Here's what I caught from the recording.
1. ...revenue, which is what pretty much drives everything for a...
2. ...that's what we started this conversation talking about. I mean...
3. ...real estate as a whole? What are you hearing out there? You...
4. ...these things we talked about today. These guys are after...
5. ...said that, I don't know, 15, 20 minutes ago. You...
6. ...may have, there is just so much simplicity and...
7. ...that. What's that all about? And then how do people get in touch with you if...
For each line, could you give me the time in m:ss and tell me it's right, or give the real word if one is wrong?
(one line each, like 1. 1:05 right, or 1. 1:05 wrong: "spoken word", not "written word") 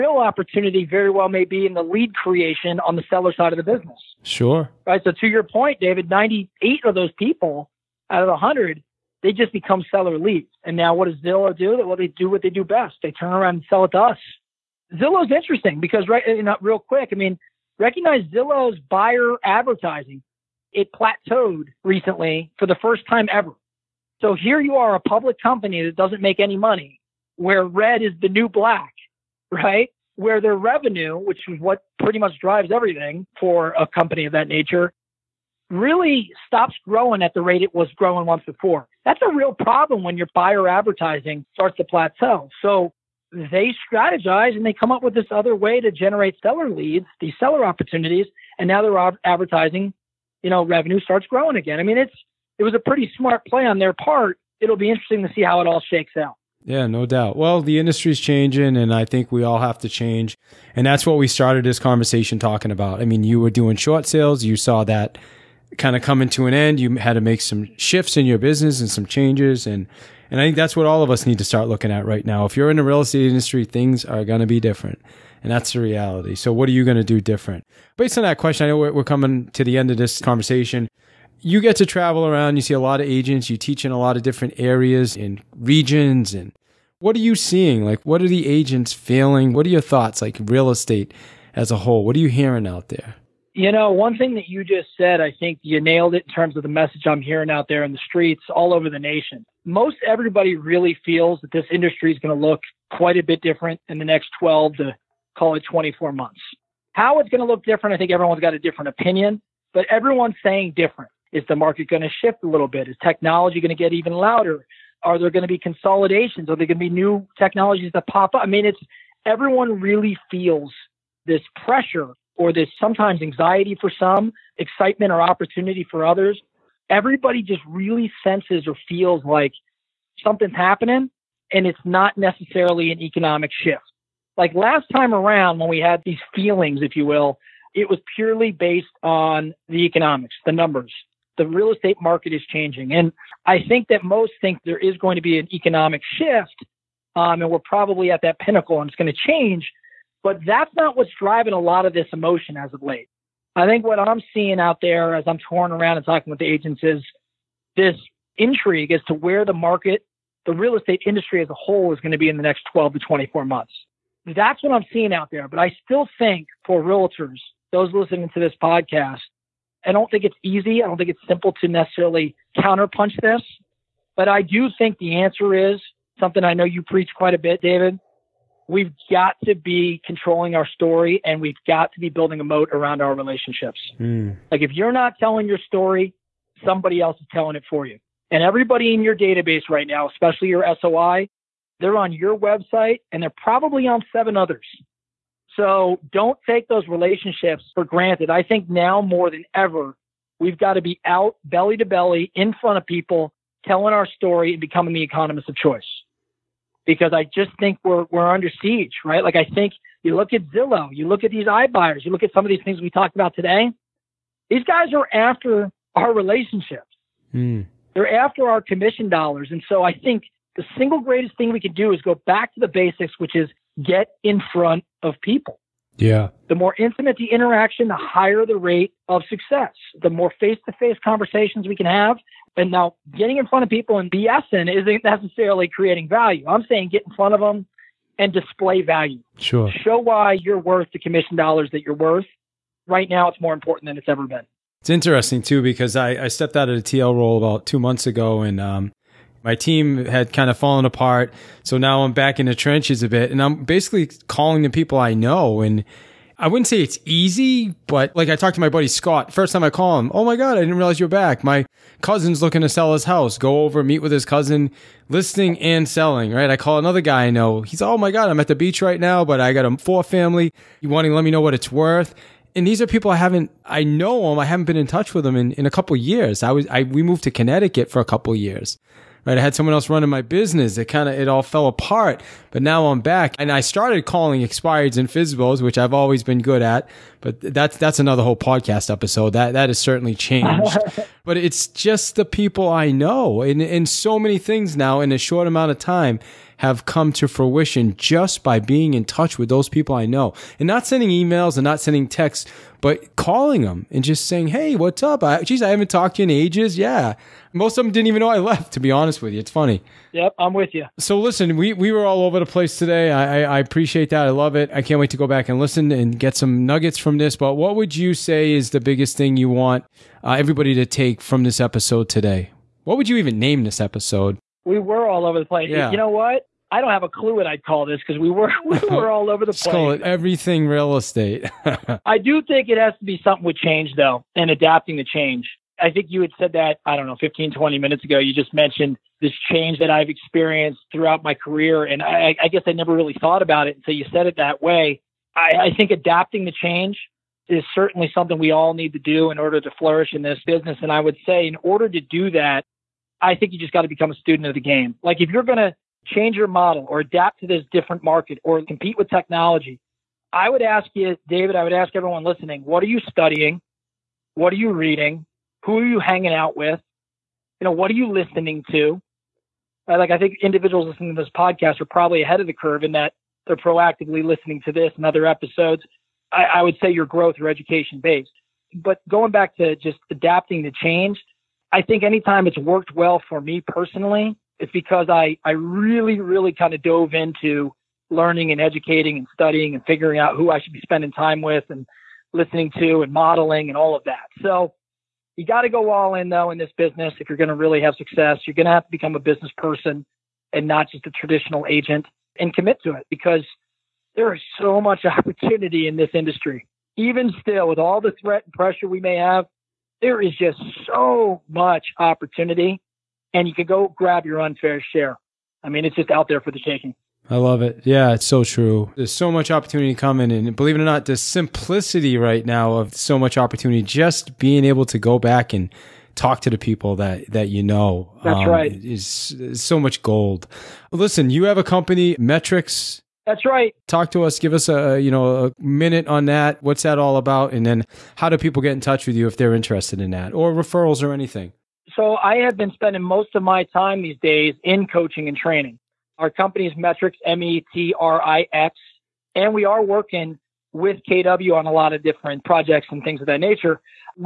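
1. 0:30 right
2. 1:00 right
3. 1:30 right
4. 3:32 right
5. 5:36 right
6. 6:49 wrong: "opportunity", not "simplicity"
7. 7:16 right.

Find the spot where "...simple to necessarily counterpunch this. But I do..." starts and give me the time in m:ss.
2:51.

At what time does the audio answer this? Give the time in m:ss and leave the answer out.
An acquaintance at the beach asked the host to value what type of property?
4:29.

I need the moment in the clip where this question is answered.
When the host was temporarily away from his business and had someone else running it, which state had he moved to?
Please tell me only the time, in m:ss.
4:37.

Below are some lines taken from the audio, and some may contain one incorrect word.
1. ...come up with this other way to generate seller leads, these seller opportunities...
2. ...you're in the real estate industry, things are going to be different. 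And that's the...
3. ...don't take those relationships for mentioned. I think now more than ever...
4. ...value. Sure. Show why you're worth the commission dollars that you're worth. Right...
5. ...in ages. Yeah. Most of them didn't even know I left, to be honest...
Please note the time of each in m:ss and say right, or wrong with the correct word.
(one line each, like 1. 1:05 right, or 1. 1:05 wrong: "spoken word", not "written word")
1. 0:44 right
2. 1:12 right
3. 3:16 wrong: "granted", not "mentioned"
4. 3:58 right
5. 5:06 right.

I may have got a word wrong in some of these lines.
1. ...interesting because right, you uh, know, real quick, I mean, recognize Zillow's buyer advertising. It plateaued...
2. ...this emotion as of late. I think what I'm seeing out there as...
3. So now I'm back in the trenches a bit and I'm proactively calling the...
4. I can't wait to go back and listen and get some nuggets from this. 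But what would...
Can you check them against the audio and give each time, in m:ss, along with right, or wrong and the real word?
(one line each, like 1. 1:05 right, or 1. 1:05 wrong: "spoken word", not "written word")
1. 0:15 right
2. 2:31 right
3. 4:11 wrong: "basically", not "proactively"
4. 5:14 right.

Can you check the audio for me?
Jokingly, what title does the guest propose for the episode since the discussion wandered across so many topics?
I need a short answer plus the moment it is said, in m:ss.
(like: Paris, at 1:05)
everything real estate, at 5:30.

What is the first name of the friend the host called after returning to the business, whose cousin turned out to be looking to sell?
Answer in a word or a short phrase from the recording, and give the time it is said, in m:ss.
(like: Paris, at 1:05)
Scott, at 4:18.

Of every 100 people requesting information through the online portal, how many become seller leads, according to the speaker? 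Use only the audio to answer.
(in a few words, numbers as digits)
98.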